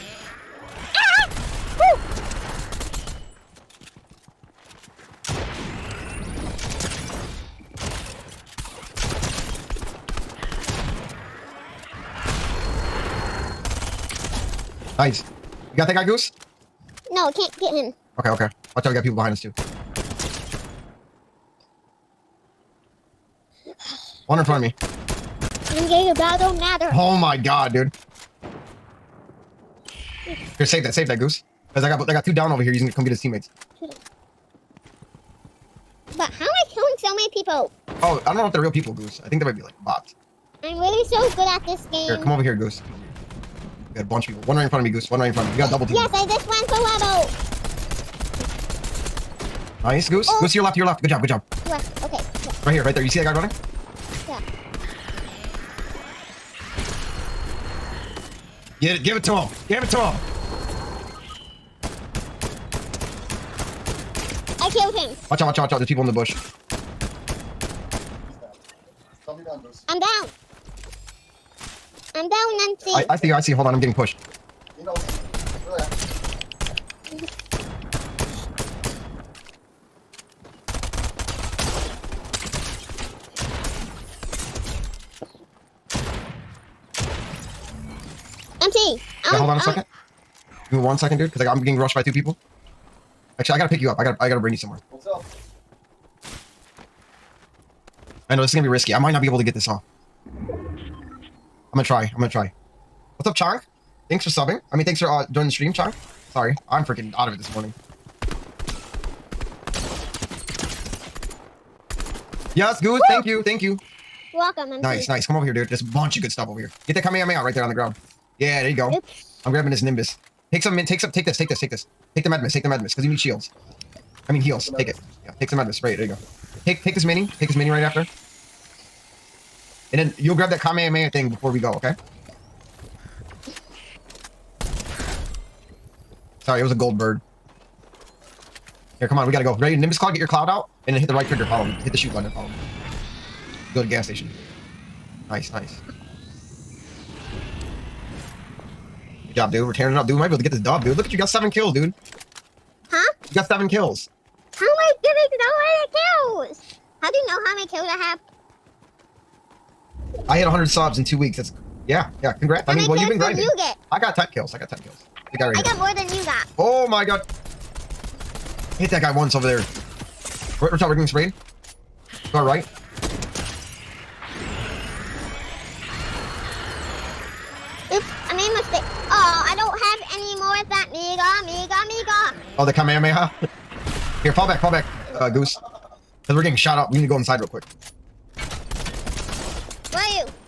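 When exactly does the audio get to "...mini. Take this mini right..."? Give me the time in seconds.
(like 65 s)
127 s.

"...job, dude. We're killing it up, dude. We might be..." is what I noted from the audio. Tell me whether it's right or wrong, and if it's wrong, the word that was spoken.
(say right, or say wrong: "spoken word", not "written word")
wrong: "tearing", not "killing".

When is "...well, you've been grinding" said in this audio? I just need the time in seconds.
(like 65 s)
162 s.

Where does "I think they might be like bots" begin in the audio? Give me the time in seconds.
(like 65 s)
39 s.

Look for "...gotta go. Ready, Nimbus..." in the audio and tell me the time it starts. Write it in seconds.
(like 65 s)
139 s.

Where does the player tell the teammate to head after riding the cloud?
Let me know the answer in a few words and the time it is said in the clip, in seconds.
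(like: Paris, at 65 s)
Gas station, at 143 s.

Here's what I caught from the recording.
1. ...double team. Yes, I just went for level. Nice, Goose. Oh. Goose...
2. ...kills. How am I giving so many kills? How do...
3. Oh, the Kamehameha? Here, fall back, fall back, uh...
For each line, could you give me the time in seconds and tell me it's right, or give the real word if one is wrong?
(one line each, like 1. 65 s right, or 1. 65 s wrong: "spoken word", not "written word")
1. 45 s right
2. 153 s right
3. 182 s right.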